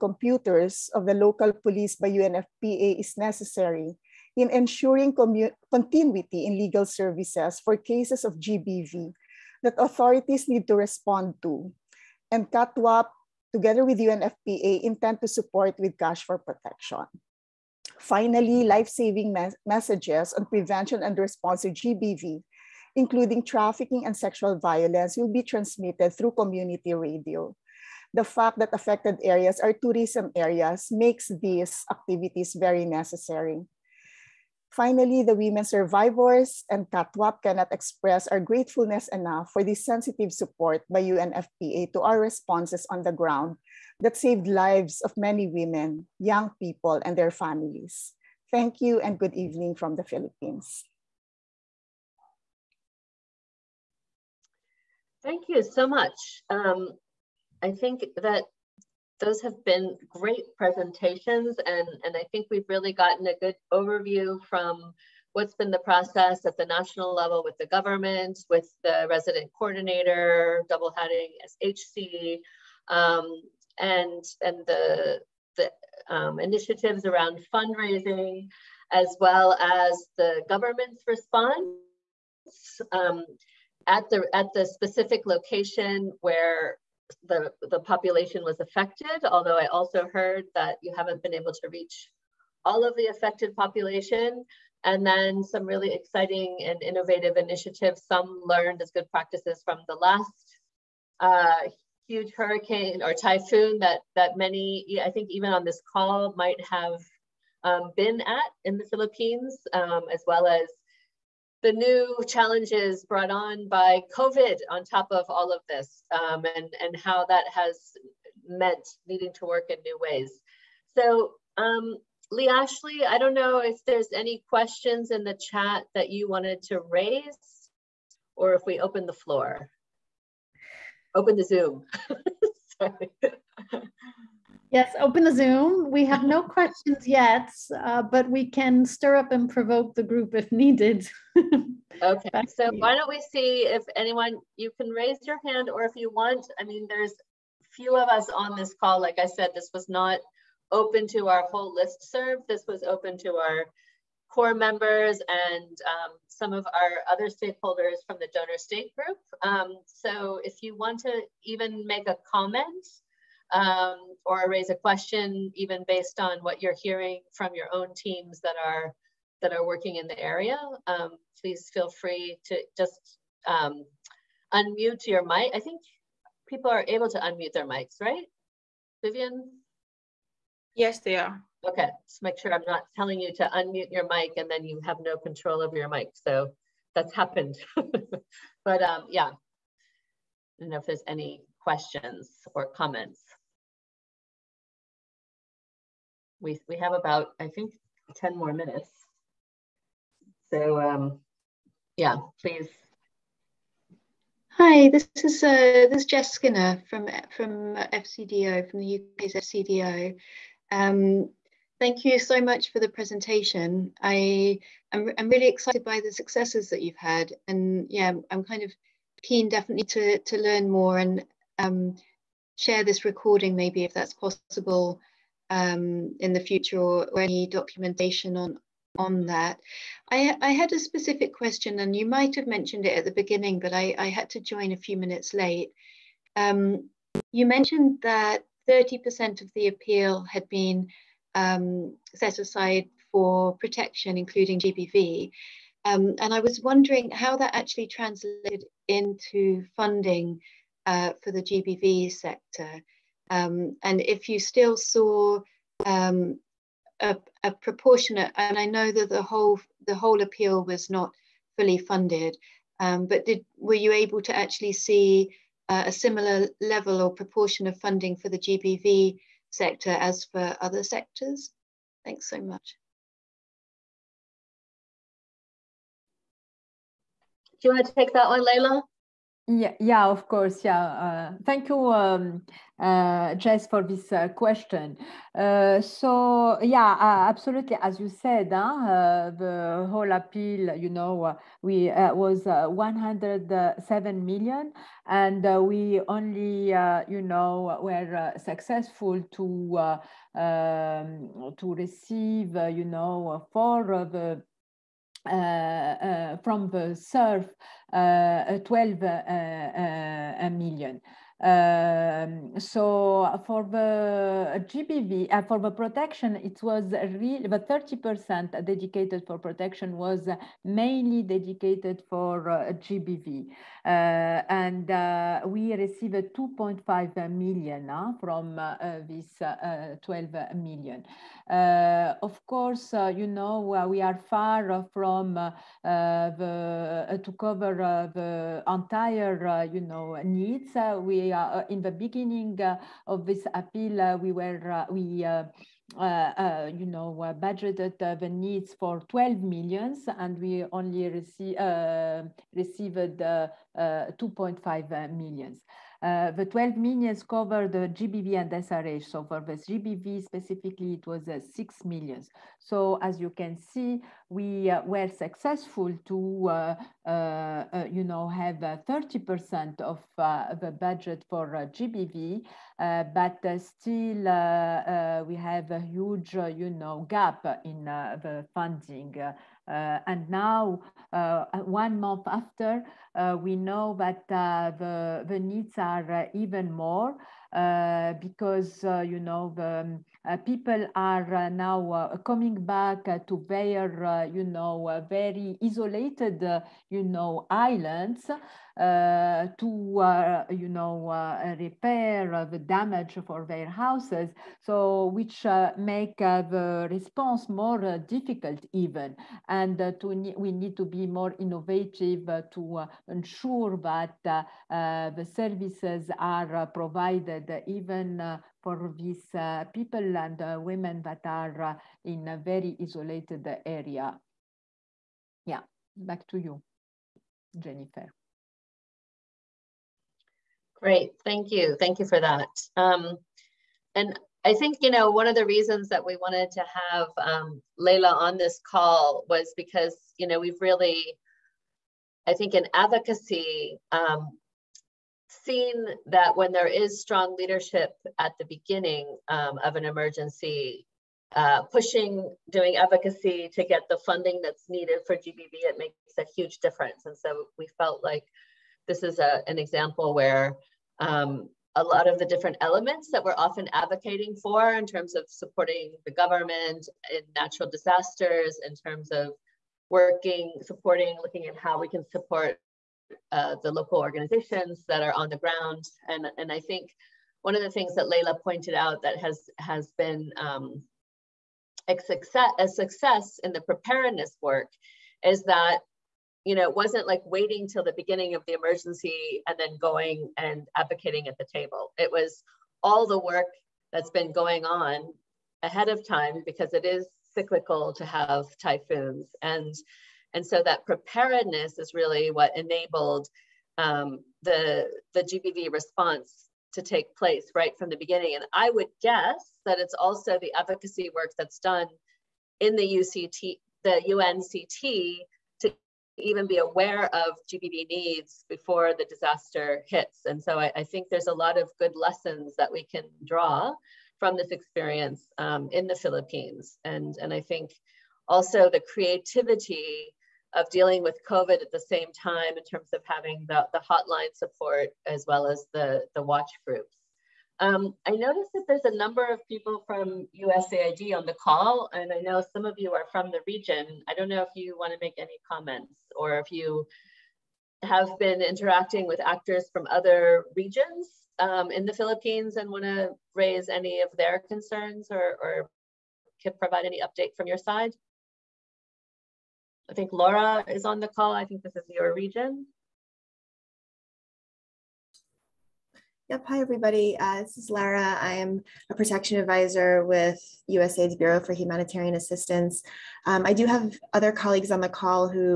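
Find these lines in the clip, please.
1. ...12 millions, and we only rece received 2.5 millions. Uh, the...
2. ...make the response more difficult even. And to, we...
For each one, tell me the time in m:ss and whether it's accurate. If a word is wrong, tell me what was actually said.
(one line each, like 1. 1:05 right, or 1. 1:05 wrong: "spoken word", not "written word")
1. 5:49 right
2. 6:45 right.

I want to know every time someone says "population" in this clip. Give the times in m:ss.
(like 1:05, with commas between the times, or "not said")
1:27, 1:33.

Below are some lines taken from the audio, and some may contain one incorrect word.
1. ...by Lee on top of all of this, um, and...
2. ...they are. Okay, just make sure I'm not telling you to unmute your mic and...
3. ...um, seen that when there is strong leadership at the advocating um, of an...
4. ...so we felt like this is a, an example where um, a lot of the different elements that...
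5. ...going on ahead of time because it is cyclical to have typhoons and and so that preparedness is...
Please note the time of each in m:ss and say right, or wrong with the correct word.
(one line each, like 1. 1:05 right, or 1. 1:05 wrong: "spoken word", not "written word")
1. 1:53 wrong: "COVID", not "Lee"
2. 3:01 right
3. 7:23 wrong: "beginning", not "advocating"
4. 7:37 right
5. 8:14 right.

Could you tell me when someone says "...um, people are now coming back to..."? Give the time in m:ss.
6:30.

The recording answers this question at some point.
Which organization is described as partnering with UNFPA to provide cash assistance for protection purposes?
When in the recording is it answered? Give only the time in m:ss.
0:12.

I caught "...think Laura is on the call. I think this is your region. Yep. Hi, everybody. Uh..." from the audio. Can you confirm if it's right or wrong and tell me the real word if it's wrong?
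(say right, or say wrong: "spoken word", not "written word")
right.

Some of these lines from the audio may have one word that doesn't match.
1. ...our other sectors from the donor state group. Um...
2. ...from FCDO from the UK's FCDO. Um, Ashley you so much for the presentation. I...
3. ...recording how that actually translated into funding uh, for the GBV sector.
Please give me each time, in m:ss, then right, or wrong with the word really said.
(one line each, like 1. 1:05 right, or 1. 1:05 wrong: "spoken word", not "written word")
1. 2:36 wrong: "stakeholders", not "sectors"
2. 3:27 wrong: "Thank", not "Ashley"
3. 4:06 wrong: "wondering", not "recording".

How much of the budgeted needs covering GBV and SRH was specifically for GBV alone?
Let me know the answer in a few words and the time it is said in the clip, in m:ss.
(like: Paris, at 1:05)
6 million, at 6:01.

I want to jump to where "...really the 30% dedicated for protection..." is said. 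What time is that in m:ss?
5:16.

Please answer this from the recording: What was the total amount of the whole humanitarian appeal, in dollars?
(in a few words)
107 million.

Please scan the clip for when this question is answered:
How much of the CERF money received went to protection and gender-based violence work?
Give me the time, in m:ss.
5:26.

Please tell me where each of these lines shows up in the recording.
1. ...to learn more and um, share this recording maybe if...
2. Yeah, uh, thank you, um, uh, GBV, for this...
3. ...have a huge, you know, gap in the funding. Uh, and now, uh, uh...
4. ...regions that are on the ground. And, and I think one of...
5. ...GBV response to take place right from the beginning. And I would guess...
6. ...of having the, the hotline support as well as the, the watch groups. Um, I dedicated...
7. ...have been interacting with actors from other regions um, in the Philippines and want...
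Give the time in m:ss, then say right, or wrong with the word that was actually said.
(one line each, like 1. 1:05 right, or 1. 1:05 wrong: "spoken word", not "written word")
1. 3:40 right
2. 4:40 wrong: "Jess", not "GBV"
3. 6:15 right
4. 7:53 wrong: "organizations", not "regions"
5. 8:25 right
6. 8:52 wrong: "noticed", not "dedicated"
7. 9:07 right.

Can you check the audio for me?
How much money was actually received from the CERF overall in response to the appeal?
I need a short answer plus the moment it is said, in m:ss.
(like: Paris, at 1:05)
12 million, at 5:08.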